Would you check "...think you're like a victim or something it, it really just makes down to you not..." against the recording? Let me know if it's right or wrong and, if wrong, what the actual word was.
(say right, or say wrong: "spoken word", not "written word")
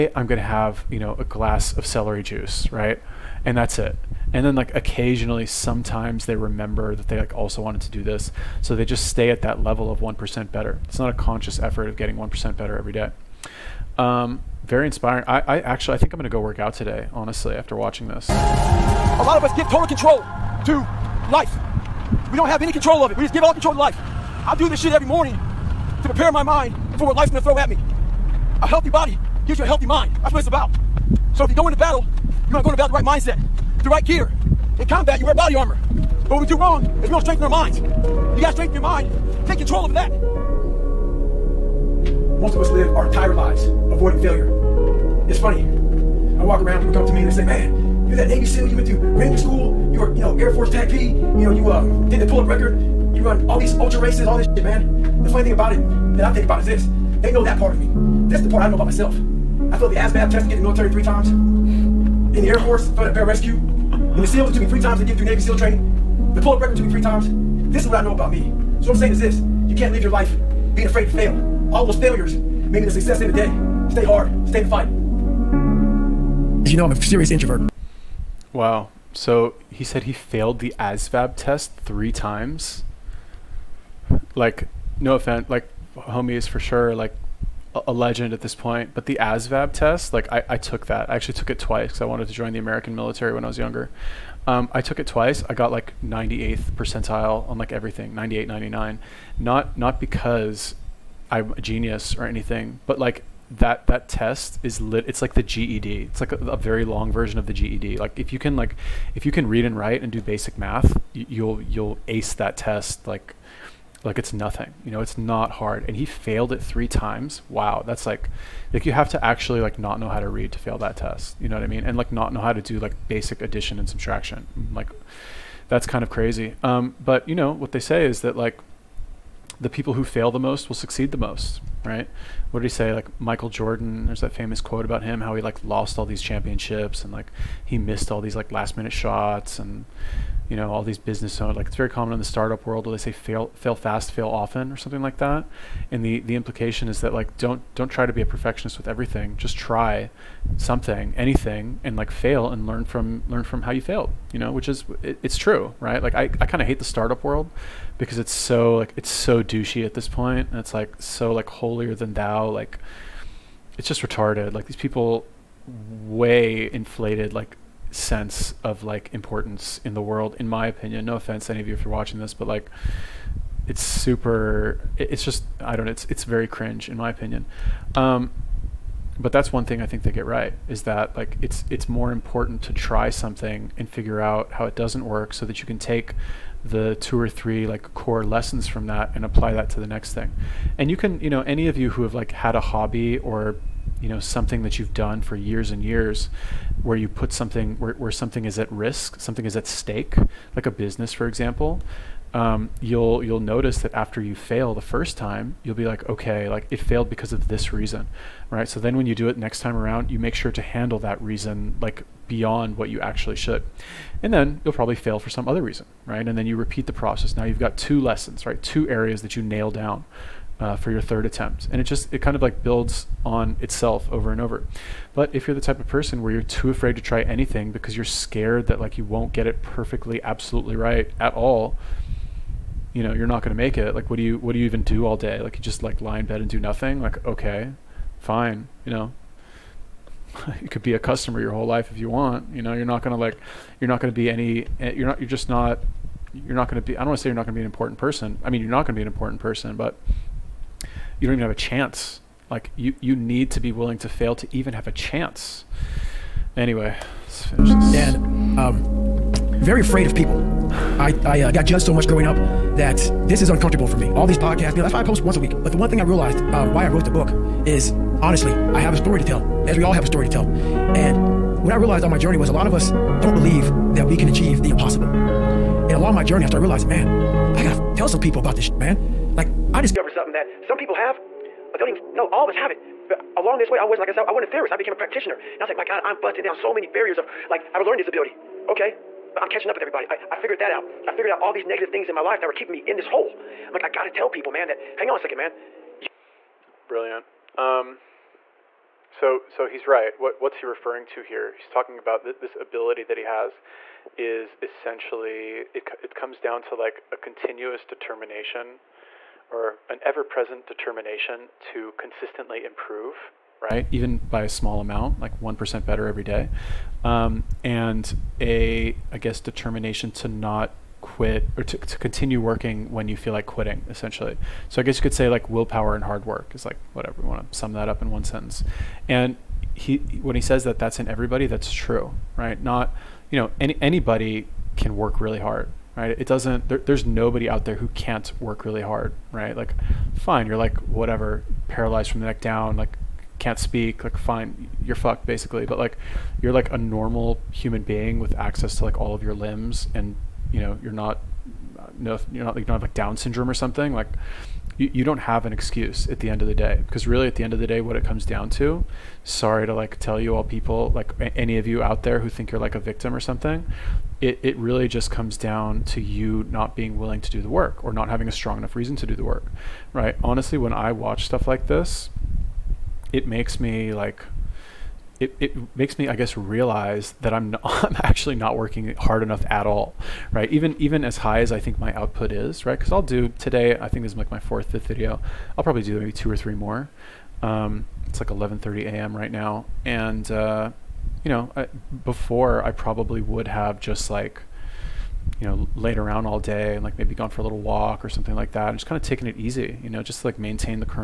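wrong: "comes", not "makes".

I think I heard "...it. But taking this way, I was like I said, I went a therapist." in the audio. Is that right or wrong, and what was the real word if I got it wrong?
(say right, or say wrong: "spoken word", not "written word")
wrong: "along", not "taking".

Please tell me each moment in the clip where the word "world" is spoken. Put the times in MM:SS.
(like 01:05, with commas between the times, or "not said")
02:22, 02:37, 02:50.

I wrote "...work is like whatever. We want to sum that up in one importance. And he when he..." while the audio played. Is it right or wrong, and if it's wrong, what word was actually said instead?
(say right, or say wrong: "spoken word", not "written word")
wrong: "sentence", not "importance".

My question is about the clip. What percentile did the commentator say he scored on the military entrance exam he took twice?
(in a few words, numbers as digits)
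98th percentile.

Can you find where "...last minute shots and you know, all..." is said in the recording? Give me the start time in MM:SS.
02:18.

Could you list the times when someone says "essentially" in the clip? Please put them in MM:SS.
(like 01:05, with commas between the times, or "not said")
05:04, 05:23.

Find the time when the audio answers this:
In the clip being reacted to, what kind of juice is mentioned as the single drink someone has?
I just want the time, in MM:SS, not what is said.
00:01.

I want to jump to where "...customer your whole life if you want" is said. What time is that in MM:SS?
04:00.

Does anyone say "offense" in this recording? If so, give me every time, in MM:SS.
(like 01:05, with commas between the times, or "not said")
01:25, 02:51.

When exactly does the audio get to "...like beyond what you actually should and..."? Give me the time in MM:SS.
03:31.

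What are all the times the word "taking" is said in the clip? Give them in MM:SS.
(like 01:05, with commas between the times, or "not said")
06:39.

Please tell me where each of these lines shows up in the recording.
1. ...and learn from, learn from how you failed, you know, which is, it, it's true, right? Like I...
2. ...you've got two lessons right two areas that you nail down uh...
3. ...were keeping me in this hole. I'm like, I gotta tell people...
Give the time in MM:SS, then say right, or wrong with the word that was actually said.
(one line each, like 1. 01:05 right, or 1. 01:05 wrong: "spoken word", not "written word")
1. 02:32 right
2. 03:37 right
3. 04:52 right.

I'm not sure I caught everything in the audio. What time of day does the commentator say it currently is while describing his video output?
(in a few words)
11:30 a.m.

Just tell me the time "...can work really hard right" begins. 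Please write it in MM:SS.
05:34.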